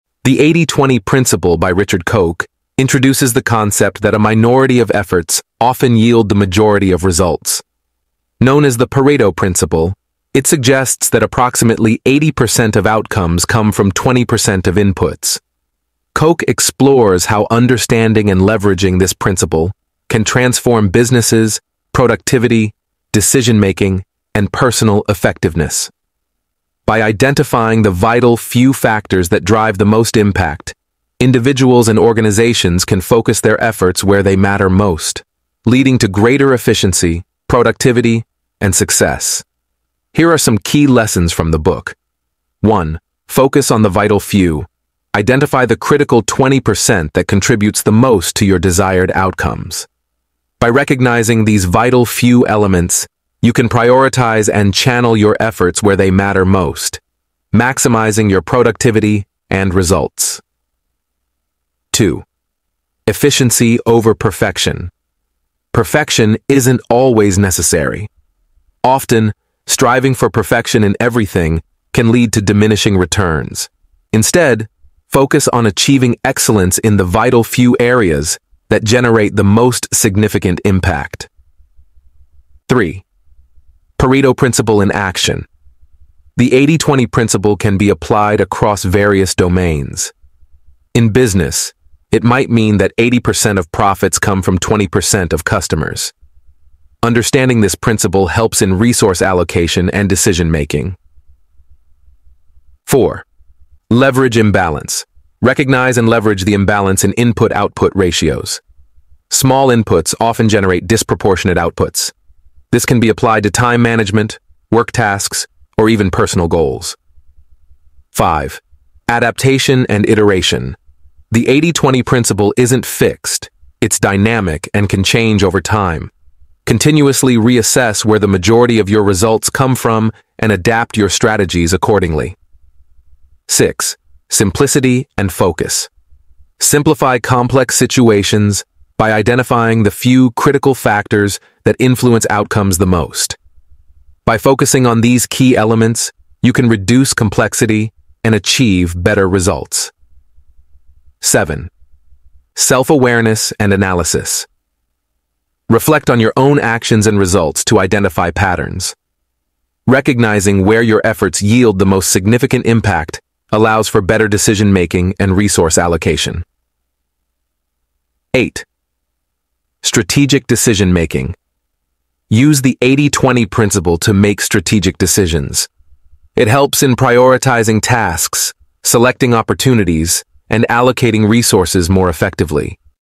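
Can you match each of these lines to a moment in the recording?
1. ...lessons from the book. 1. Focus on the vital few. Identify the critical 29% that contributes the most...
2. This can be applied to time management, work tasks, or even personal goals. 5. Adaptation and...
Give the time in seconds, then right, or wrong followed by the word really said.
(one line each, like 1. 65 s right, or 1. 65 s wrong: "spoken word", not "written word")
1. 40 s wrong: "20", not "29"
2. 112 s right.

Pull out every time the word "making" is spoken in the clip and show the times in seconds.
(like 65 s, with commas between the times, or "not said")
23 s, 100 s, 164 s, 170 s.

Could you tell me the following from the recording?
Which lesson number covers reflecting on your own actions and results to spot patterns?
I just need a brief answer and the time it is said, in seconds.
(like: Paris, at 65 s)
7, at 151 s.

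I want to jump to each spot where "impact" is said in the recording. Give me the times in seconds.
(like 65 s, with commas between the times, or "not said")
30 s, 80 s, 162 s.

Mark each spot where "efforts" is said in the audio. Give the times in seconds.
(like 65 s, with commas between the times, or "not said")
4 s, 33 s, 55 s, 161 s.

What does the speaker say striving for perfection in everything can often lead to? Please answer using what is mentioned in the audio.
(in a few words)
diminishing returns.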